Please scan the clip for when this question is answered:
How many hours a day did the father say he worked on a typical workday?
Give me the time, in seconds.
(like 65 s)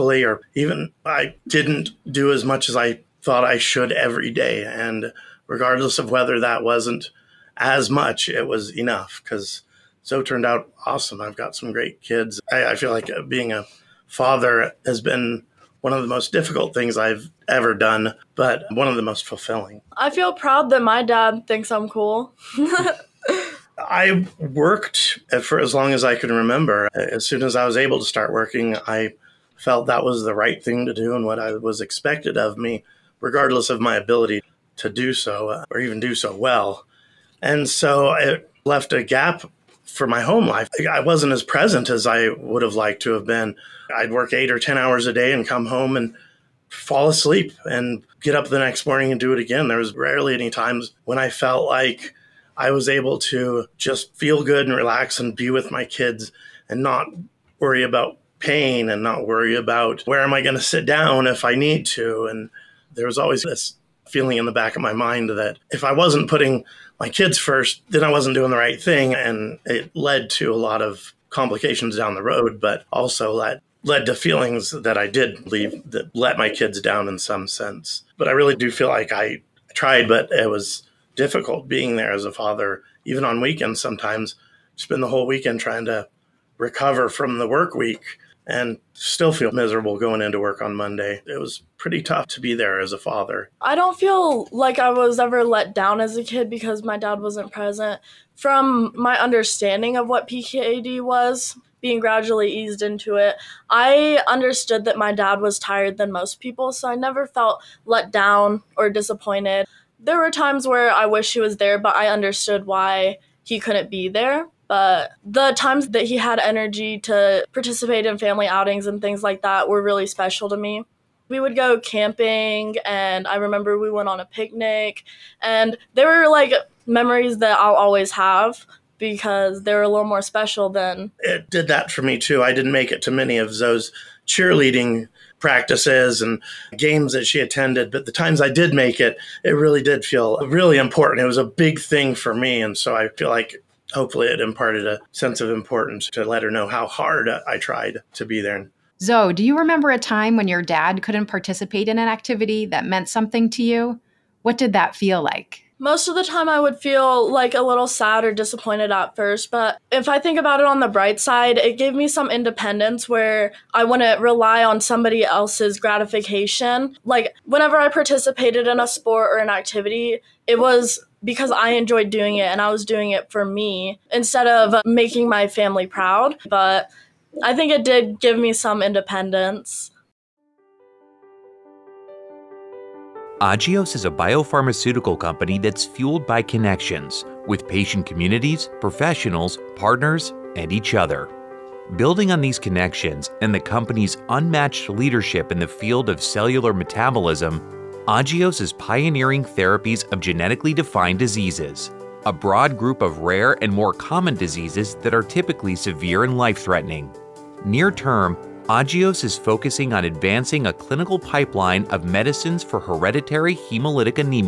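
44 s.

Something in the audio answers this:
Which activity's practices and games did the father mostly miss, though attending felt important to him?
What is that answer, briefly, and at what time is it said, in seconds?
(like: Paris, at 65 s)
Cheerleading, at 134 s.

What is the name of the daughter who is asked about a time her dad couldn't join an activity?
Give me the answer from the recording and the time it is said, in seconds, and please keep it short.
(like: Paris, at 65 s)
Zoe, at 149 s.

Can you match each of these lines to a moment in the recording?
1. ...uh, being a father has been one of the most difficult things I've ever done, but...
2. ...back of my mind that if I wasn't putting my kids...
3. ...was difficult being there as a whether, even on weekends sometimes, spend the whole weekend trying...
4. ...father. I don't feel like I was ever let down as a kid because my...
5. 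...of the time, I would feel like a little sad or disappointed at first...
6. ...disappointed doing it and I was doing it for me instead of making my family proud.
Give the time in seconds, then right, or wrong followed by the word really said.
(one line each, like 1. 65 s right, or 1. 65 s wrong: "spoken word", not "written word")
1. 13 s right
2. 64 s right
3. 80 s wrong: "father", not "whether"
4. 92 s right
5. 156 s right
6. 171 s wrong: "enjoyed", not "disappointed".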